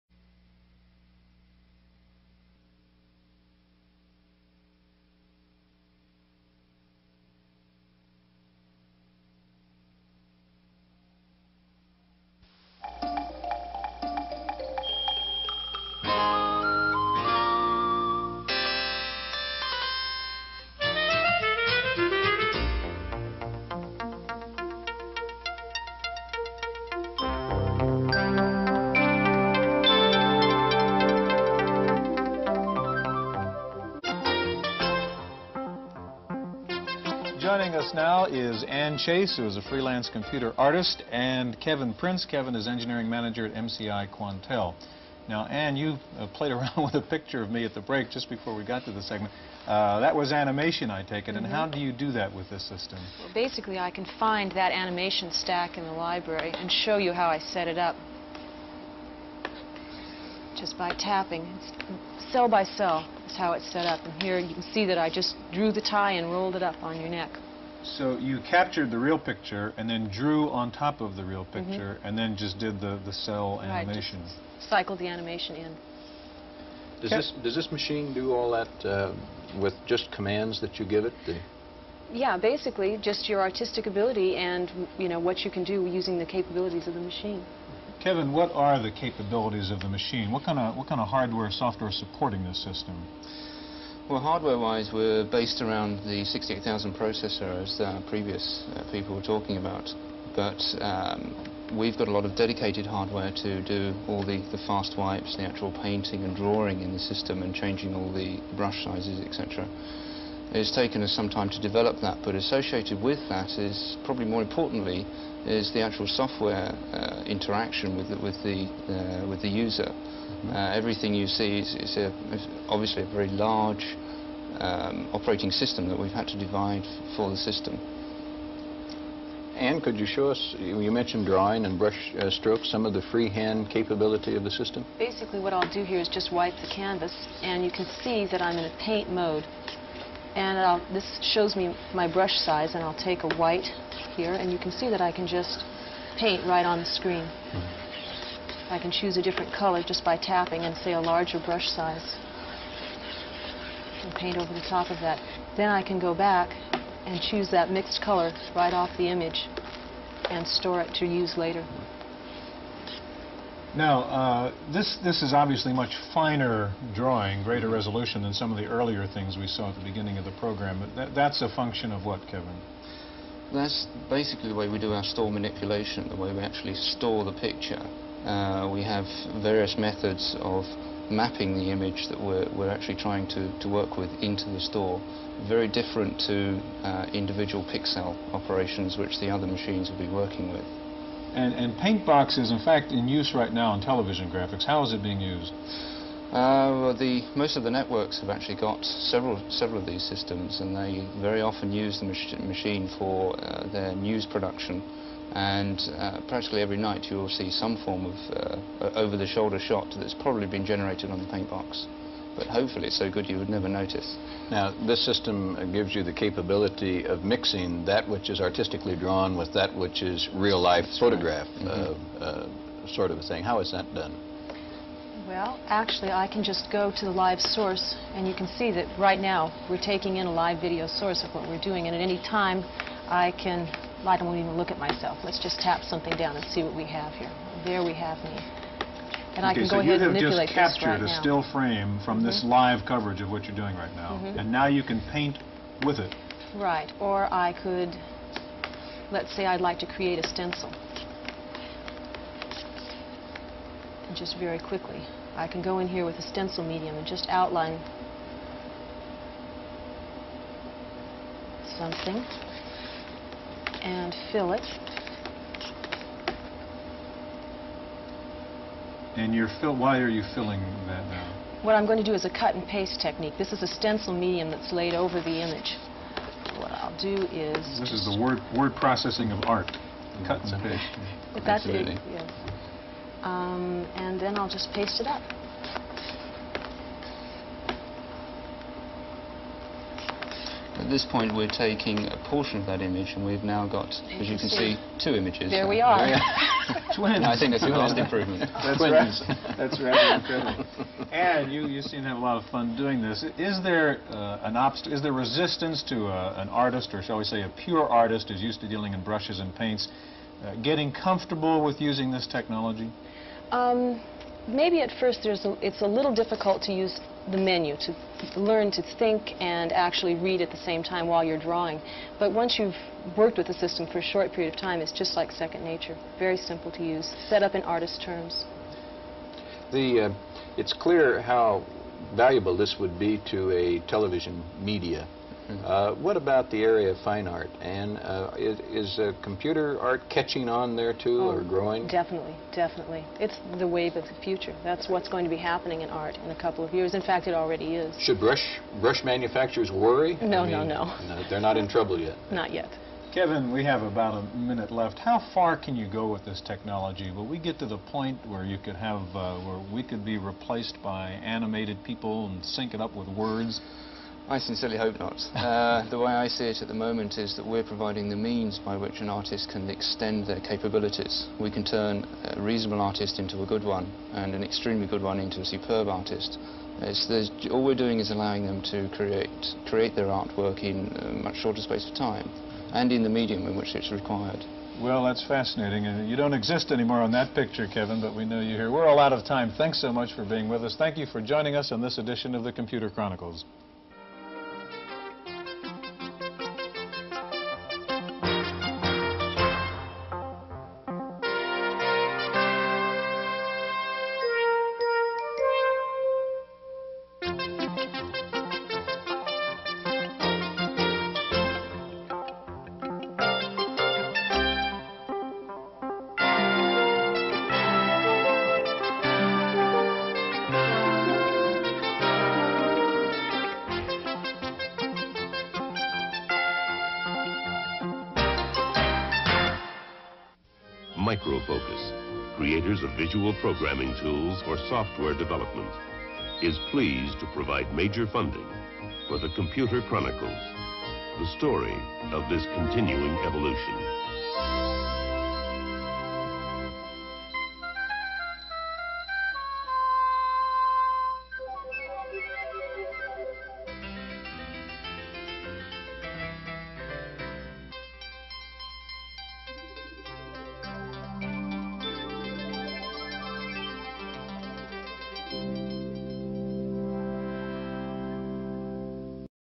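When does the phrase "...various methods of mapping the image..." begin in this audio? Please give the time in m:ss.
2:59.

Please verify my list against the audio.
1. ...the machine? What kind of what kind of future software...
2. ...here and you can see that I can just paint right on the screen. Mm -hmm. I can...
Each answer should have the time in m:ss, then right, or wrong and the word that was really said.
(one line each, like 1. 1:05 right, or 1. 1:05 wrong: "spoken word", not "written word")
1. 1:29 wrong: "hardware", not "future"
2. 2:24 right.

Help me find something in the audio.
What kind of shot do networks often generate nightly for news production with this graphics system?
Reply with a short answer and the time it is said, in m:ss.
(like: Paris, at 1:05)
Over-the-shoulder shot, at 3:28.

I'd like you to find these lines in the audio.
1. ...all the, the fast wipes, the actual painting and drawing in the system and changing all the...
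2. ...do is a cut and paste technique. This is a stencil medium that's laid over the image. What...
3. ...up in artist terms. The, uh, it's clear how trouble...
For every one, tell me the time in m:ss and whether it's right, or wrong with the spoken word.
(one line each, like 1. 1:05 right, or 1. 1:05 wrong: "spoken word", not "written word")
1. 1:44 right
2. 4:32 right
3. 5:27 wrong: "valuable", not "trouble".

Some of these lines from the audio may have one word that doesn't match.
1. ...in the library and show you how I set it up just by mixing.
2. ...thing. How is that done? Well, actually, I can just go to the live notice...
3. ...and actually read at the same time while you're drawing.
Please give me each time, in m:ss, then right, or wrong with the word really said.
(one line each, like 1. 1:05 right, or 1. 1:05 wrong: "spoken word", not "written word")
1. 0:55 wrong: "tapping", not "mixing"
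2. 3:43 wrong: "source", not "notice"
3. 5:19 right.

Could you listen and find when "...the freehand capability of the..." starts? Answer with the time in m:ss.
2:12.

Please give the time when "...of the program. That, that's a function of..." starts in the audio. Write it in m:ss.
2:50.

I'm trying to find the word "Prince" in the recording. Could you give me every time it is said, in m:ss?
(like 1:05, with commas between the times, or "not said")
0:41.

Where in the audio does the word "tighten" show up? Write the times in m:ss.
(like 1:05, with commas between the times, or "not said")
not said.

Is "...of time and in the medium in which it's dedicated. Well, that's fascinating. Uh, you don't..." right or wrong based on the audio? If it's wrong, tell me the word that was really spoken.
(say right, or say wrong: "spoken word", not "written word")
wrong: "required", not "dedicated".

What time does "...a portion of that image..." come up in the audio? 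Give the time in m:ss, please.
4:52.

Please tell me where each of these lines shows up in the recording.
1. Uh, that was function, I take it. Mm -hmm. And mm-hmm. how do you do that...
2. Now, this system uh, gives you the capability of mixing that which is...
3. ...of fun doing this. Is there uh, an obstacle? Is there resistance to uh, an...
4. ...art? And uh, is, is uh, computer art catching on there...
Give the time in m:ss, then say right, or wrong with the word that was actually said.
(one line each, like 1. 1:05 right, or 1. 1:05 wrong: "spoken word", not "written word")
1. 0:49 wrong: "animation", not "function"
2. 3:34 right
3. 5:02 right
4. 5:37 right.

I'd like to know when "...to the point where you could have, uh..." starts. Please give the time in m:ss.
5:57.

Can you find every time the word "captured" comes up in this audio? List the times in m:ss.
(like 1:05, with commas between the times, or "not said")
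1:08, 4:01.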